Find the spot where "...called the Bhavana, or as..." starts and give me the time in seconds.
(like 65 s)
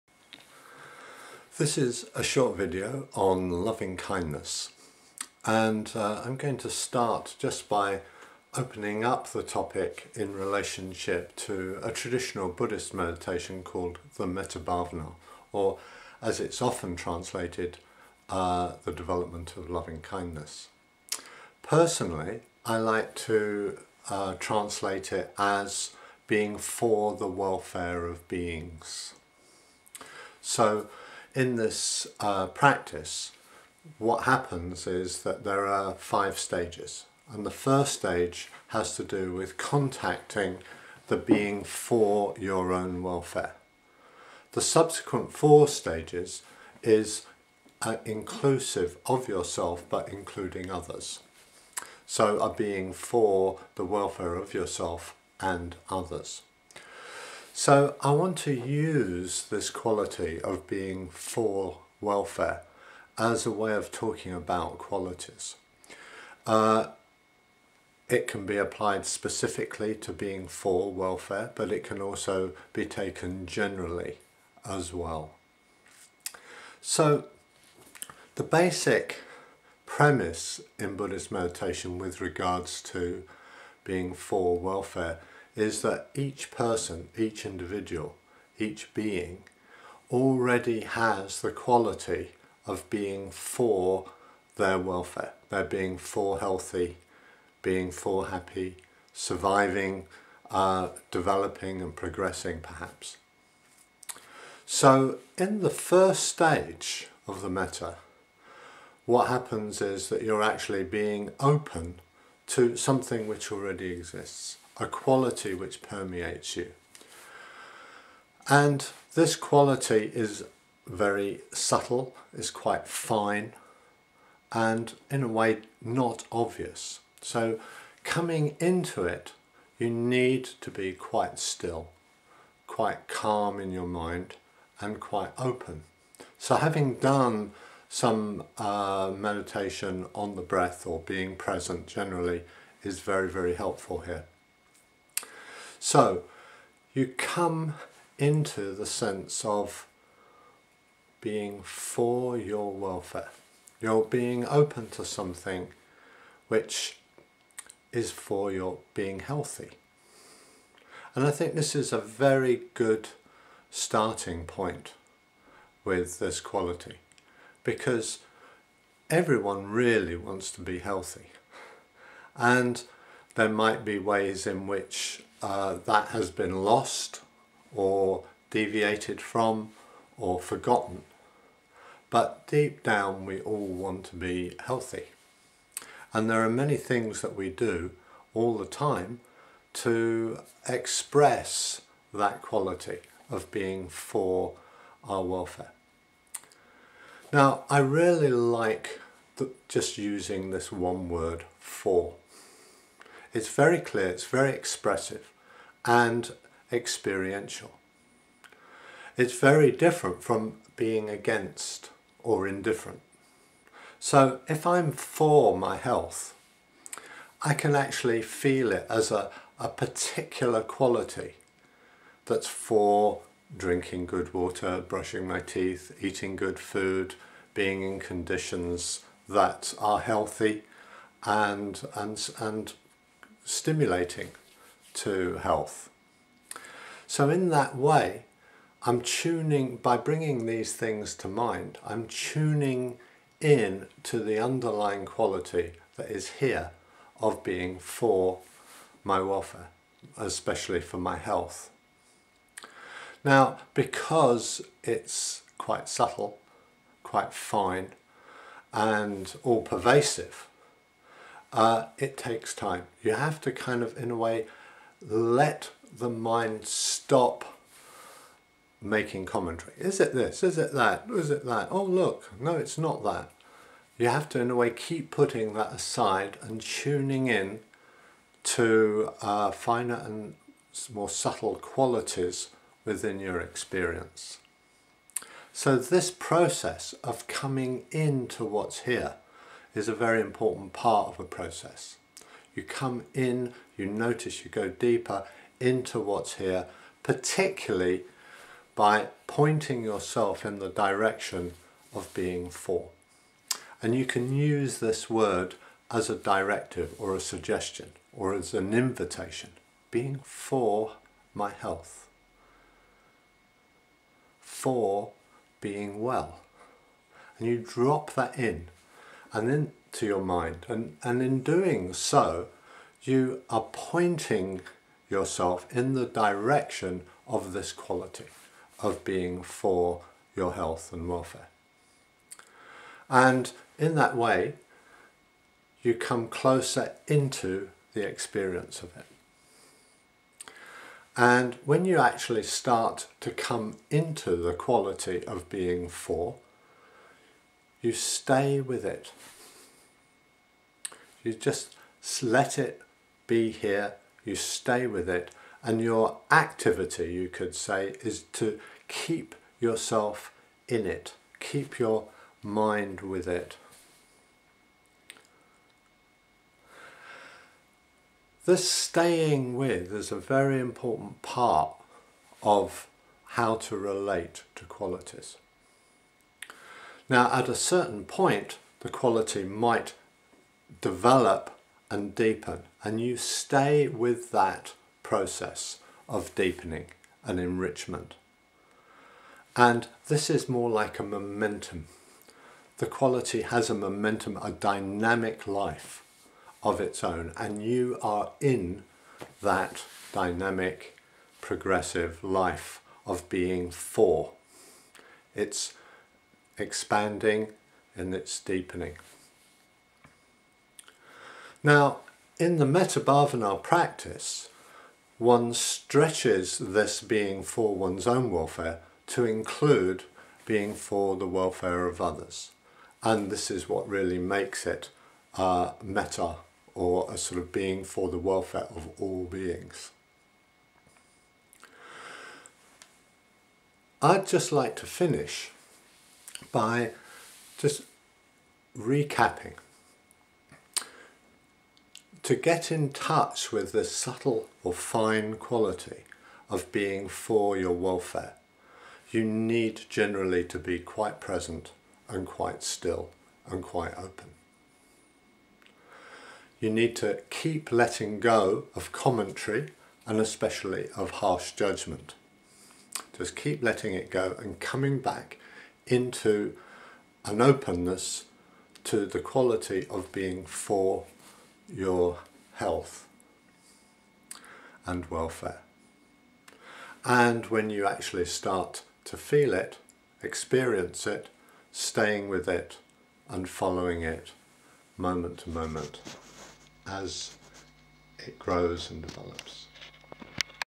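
13 s.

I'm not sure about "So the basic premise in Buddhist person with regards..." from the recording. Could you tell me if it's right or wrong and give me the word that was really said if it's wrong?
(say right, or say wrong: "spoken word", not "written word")
wrong: "meditation", not "person".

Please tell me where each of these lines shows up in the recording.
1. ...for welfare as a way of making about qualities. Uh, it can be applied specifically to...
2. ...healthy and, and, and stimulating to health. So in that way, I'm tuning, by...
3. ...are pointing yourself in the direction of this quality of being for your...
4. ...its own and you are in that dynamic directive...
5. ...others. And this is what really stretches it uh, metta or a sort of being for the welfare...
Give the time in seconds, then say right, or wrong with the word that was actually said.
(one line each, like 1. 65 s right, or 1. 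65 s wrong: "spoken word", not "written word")
1. 61 s wrong: "talking", not "making"
2. 229 s right
3. 323 s right
4. 396 s wrong: "progressive", not "directive"
5. 422 s wrong: "makes", not "stretches".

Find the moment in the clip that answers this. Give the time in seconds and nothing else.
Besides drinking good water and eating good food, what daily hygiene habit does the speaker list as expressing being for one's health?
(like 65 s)
224 s.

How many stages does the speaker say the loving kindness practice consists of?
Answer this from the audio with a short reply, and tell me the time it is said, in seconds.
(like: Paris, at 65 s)
5, at 35 s.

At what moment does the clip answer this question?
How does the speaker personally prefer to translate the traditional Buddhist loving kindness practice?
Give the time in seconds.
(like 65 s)
26 s.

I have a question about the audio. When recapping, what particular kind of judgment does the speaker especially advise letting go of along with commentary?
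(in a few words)
harsh judgment.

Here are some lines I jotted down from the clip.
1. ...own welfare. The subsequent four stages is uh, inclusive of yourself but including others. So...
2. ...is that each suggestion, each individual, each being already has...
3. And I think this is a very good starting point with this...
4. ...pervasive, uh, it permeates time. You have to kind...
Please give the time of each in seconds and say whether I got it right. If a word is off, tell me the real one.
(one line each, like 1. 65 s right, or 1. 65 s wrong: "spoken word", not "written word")
1. 42 s right
2. 85 s wrong: "person", not "suggestion"
3. 161 s right
4. 259 s wrong: "takes", not "permeates".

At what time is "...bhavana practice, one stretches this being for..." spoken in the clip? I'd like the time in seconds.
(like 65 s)
412 s.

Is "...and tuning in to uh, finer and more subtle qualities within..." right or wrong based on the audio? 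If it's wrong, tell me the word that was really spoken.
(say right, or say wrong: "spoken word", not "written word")
right.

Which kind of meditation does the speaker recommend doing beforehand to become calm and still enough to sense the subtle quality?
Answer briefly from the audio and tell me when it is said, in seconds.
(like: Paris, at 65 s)
meditation on the breath, at 139 s.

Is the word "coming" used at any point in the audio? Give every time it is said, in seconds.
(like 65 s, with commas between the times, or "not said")
128 s, 287 s, 464 s.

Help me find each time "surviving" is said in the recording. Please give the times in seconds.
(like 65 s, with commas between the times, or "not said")
99 s.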